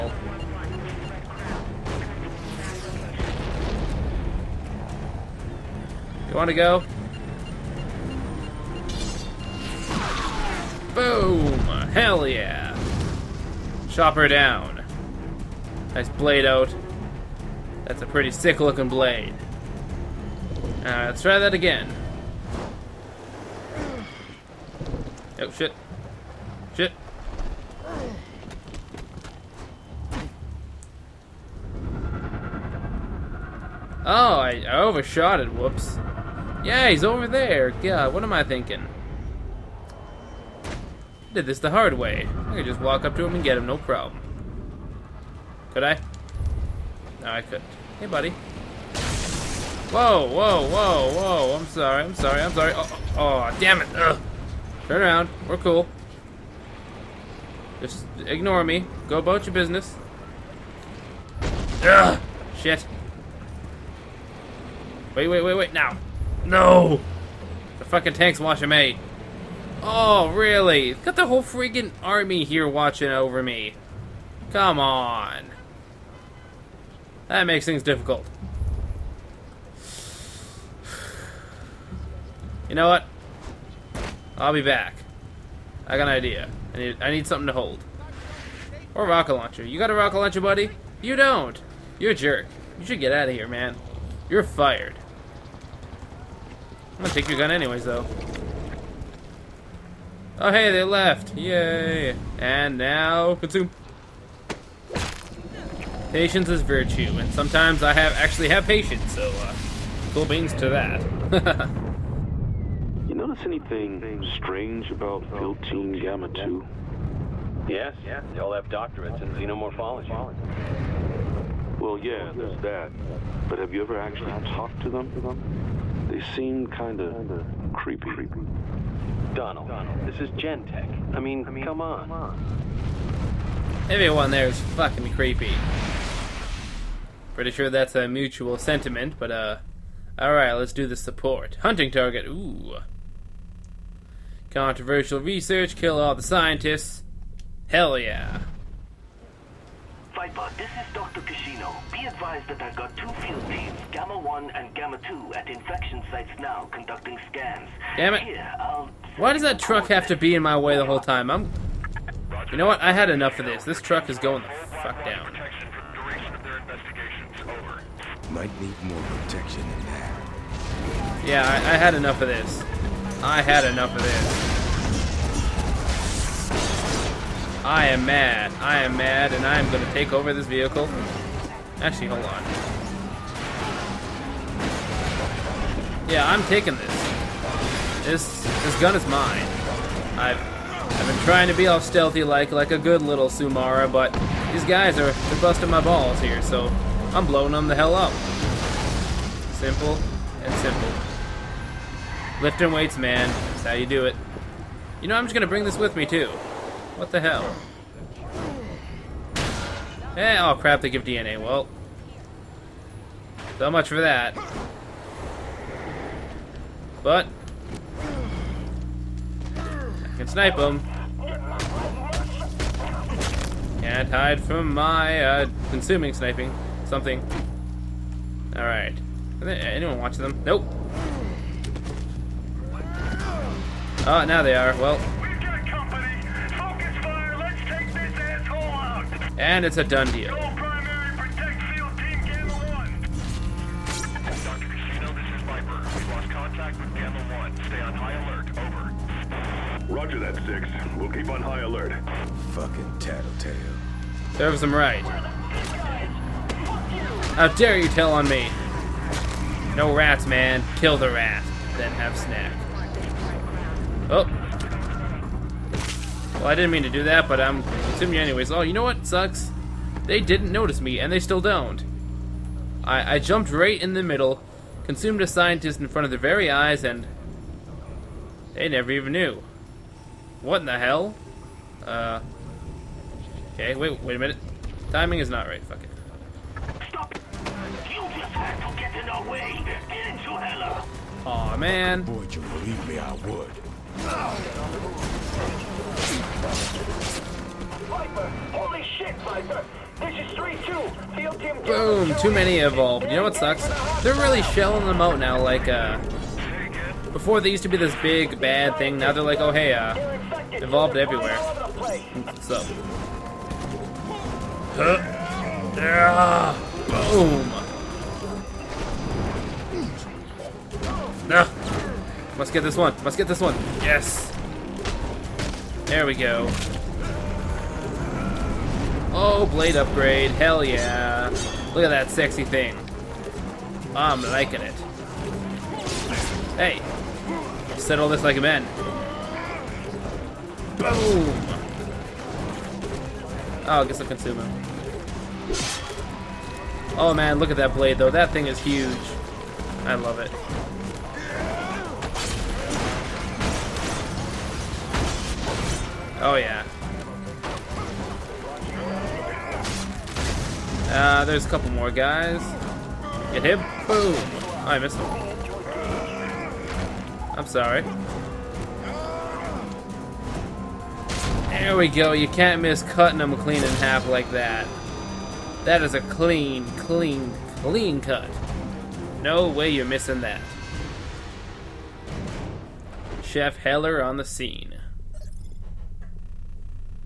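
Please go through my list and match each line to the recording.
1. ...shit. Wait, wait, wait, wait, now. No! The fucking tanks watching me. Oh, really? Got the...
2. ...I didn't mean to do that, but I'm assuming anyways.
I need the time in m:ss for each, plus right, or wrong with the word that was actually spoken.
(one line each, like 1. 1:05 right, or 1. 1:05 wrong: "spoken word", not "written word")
1. 1:02 right
2. 4:26 right.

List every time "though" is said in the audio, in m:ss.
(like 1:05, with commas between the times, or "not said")
1:37, 5:47.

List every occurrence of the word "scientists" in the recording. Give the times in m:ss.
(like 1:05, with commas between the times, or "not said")
2:26, 4:35.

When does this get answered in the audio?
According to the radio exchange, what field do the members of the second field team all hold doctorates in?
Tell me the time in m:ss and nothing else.
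1:59.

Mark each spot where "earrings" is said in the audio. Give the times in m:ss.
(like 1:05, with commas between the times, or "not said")
not said.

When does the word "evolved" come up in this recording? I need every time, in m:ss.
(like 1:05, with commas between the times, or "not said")
5:02, 5:10.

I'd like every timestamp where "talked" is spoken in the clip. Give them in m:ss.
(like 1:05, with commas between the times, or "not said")
2:04.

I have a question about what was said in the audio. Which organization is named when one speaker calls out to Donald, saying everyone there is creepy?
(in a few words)
Gentek.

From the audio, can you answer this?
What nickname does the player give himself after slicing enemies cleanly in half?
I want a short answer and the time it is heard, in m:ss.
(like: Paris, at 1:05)
Chef Heller, at 6:23.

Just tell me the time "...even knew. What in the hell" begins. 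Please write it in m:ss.
4:38.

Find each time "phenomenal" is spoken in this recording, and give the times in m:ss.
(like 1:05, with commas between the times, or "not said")
not said.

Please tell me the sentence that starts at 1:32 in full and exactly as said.
You should get out of here, man.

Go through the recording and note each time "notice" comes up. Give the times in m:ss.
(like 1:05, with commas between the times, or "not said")
1:53, 4:30.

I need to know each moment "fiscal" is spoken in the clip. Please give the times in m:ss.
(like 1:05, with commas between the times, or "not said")
not said.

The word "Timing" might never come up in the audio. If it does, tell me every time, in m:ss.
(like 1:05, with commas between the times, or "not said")
4:44.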